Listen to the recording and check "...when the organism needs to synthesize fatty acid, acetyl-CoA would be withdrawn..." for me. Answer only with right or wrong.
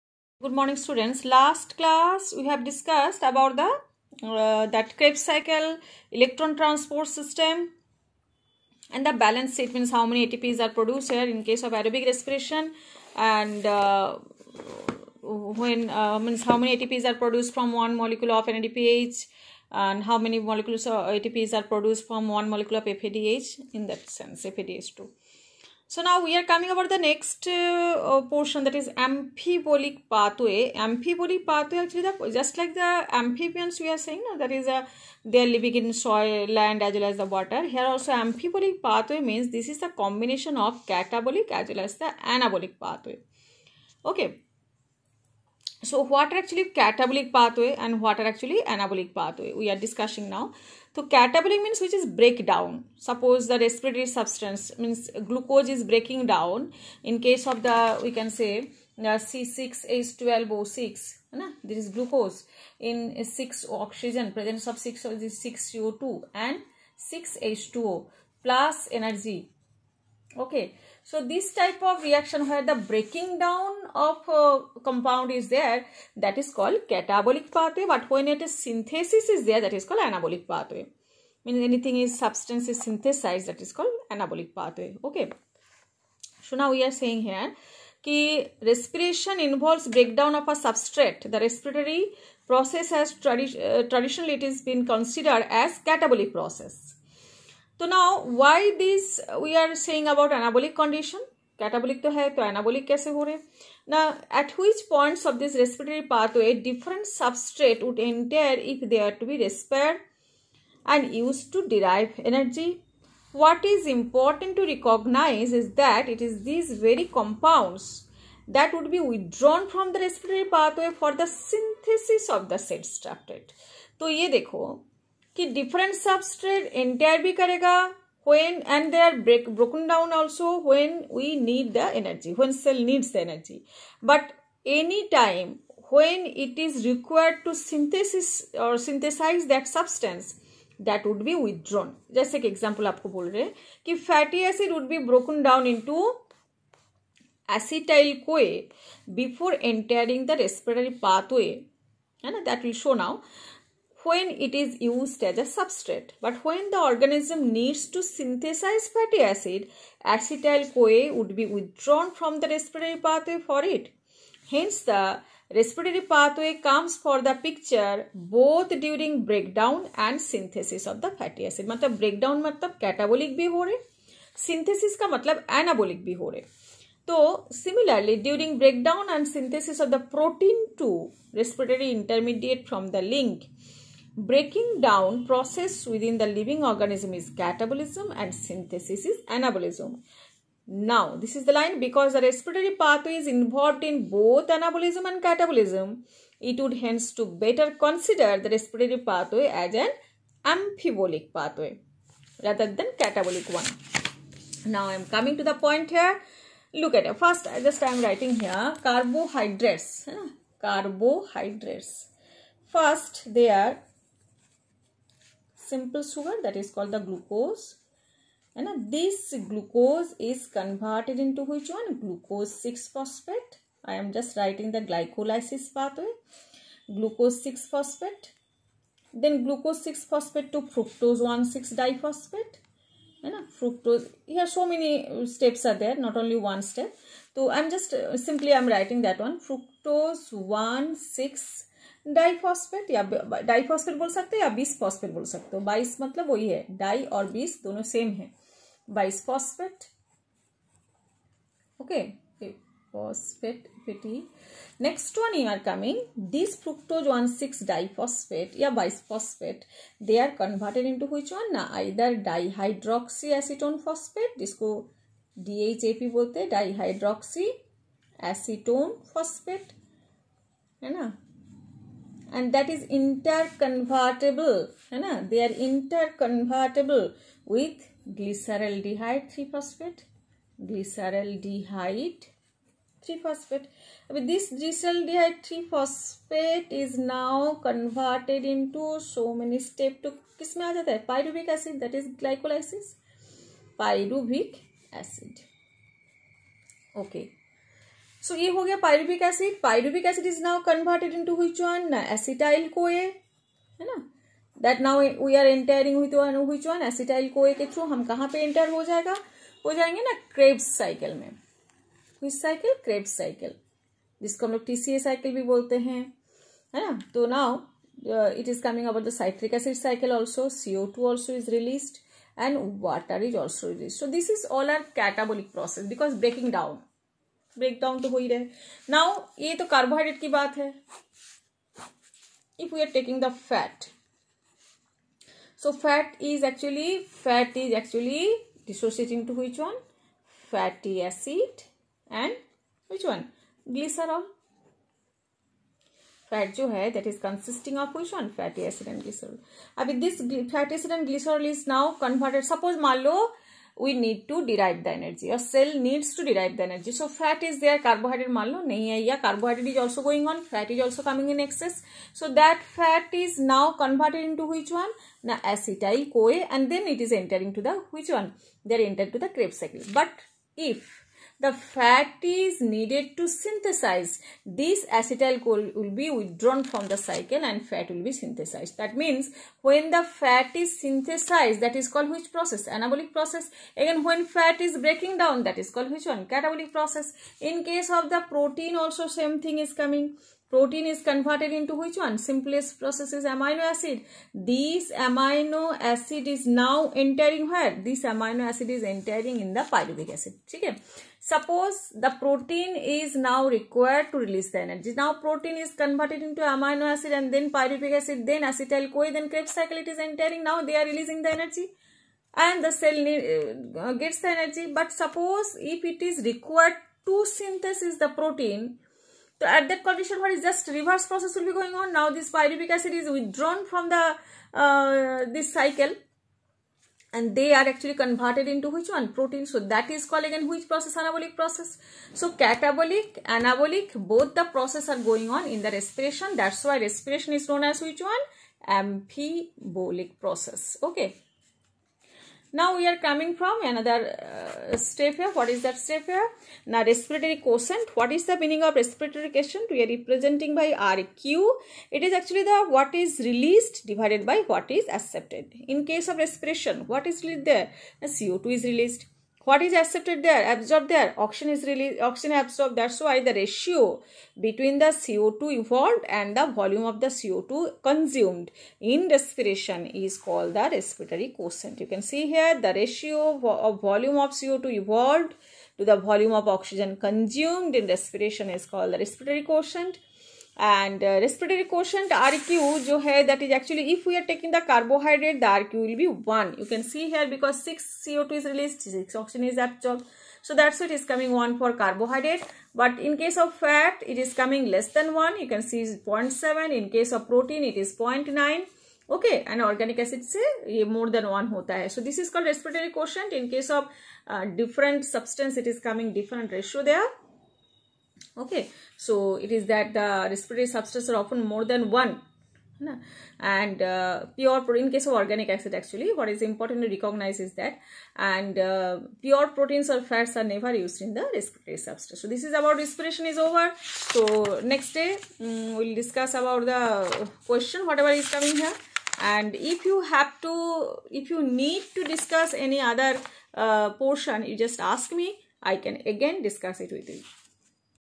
right.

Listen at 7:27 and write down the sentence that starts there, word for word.
What is the meaning of respiratory quotient?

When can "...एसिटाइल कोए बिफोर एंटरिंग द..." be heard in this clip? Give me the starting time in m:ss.
2:27.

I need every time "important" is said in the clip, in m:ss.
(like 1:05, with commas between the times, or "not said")
1:53, 8:36.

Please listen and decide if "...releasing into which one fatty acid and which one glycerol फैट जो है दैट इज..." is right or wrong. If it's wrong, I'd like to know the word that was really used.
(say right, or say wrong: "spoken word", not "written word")
wrong: "dissociating", not "releasing".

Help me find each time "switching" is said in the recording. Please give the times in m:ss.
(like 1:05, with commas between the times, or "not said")
not said.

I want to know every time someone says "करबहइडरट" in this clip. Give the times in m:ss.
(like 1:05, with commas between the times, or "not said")
5:29, 8:04, 8:11.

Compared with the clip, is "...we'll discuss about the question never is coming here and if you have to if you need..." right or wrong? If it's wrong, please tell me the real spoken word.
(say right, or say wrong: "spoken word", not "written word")
wrong: "whatever", not "never".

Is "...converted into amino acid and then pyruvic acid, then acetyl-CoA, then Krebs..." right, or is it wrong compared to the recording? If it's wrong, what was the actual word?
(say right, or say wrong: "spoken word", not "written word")
right.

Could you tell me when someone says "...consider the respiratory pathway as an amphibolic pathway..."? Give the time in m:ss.
3:17.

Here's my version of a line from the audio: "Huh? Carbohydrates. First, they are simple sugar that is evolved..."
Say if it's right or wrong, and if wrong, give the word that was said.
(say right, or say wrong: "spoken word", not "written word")
wrong: "called", not "evolved".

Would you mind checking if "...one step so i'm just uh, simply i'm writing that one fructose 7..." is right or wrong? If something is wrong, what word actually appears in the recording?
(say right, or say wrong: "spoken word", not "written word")
wrong: "1", not "7".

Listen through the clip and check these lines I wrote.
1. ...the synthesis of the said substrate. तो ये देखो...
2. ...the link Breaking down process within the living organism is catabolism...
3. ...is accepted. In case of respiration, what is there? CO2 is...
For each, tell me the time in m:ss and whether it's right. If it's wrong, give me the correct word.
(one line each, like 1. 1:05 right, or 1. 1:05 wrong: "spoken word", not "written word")
1. 2:01 right
2. 3:02 right
3. 7:34 right.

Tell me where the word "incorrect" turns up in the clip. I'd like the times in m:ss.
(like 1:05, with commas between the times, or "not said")
not said.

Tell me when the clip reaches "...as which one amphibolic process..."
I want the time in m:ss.
7:17.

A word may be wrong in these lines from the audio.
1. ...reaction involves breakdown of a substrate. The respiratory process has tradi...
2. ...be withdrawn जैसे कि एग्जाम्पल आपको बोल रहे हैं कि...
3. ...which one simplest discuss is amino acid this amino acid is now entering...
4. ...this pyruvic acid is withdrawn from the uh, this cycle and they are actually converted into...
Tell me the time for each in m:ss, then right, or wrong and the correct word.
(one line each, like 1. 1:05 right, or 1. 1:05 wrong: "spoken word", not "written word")
1. 1:28 wrong: "respiration", not "reaction"
2. 2:21 right
3. 6:31 wrong: "process", not "discuss"
4. 7:02 right.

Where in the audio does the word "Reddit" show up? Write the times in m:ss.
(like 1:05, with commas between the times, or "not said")
not said.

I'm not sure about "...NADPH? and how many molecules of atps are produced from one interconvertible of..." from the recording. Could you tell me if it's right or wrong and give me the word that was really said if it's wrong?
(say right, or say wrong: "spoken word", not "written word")
wrong: "molecule", not "interconvertible".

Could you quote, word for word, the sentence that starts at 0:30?
Amphibolic pathway actually the, just like the amphibians we are saying no?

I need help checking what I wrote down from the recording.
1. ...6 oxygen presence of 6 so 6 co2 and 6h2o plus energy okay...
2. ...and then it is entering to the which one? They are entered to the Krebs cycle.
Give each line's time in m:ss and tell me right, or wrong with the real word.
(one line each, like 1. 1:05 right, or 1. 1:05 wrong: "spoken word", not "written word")
1. 1:03 right
2. 6:06 right.